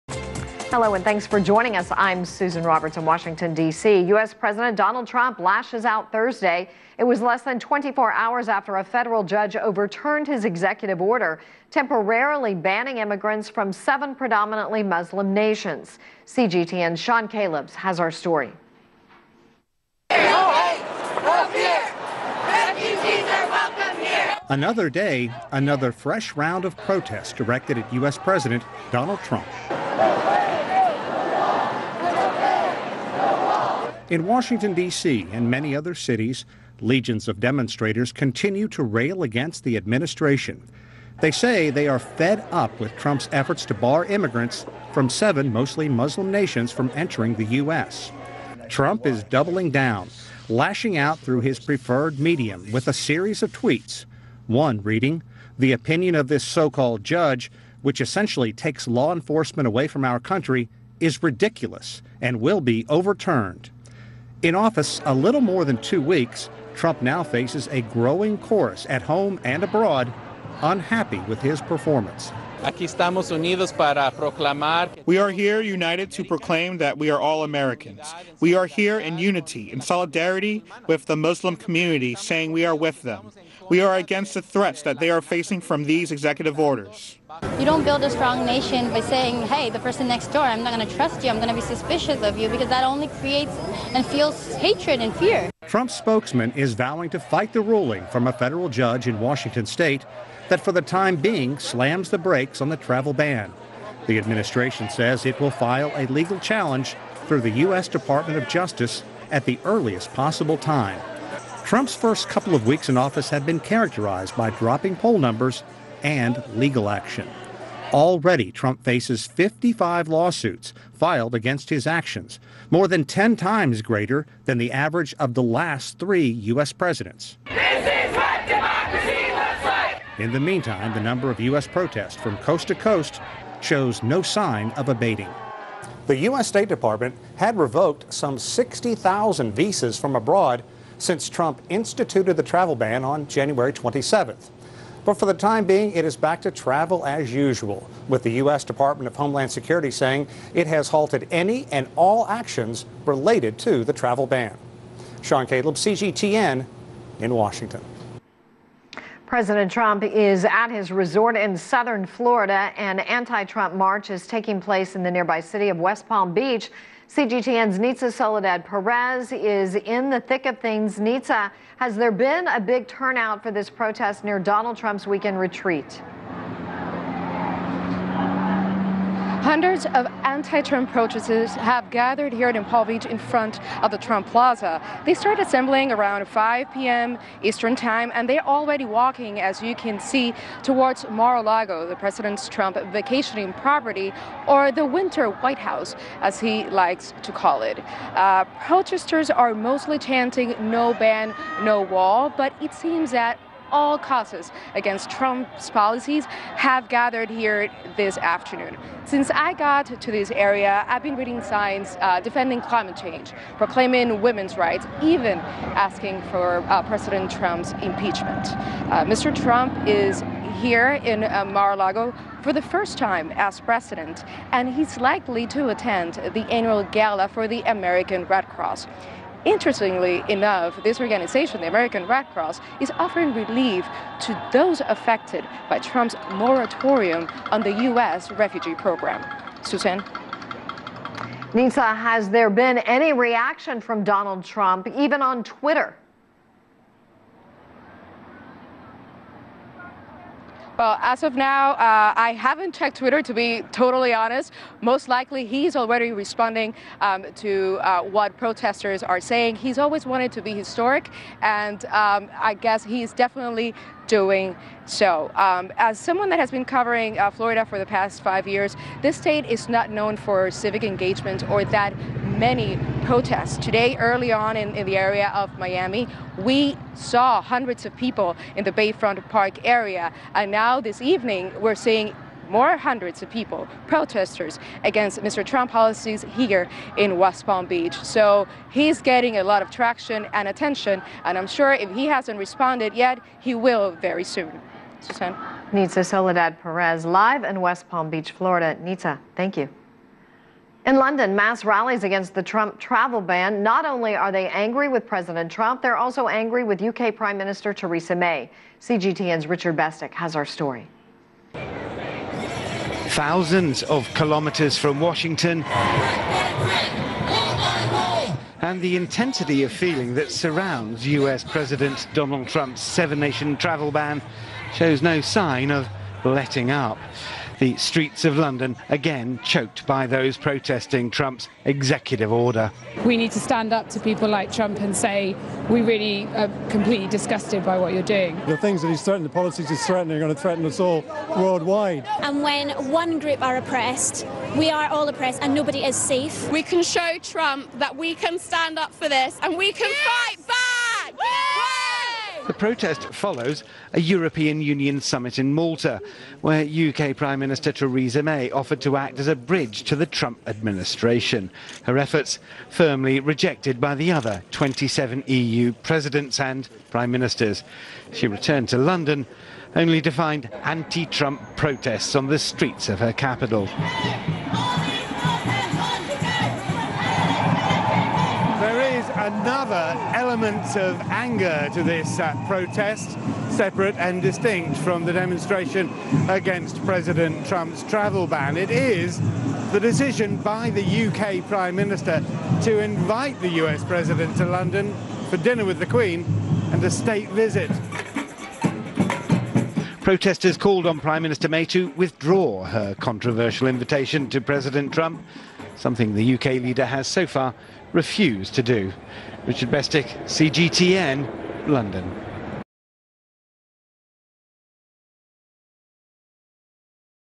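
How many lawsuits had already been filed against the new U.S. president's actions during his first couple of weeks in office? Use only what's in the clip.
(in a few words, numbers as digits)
55.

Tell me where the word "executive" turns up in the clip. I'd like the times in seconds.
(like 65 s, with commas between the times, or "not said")
10 s, 86 s, 331 s.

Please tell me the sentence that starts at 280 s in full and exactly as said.
And now this evening, we're seeing more hundreds of people, protesters against Mr.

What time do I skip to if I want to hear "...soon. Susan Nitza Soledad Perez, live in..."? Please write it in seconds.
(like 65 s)
294 s.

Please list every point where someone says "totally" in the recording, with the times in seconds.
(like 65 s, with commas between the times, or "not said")
253 s.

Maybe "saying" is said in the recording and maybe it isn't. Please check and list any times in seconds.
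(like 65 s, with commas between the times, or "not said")
82 s, 89 s, 149 s, 259 s.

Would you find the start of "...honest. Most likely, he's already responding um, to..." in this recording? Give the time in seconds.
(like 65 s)
254 s.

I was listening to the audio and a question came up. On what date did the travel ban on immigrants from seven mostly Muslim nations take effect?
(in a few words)
January 27th.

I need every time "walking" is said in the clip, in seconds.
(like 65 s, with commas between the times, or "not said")
188 s.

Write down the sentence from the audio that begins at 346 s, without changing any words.
We can show Trump that we can stand up for this and we can yes!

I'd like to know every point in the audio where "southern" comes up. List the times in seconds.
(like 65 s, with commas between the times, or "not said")
161 s.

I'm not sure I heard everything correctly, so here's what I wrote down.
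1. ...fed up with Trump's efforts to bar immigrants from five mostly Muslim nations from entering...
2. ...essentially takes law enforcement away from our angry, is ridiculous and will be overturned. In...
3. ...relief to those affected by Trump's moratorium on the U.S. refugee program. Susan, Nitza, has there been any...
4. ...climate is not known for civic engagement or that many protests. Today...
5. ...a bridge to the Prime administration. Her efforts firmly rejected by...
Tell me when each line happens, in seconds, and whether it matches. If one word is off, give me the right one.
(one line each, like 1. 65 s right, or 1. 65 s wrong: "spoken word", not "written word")
1. 41 s wrong: "seven", not "five"
2. 58 s wrong: "country", not "angry"
3. 233 s right
4. 269 s wrong: "state", not "climate"
5. 359 s wrong: "Trump", not "Prime".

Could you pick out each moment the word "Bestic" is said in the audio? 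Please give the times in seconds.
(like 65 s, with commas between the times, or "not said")
309 s, 409 s.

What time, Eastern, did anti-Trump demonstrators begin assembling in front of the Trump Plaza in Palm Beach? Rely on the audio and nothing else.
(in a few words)
5 p.m.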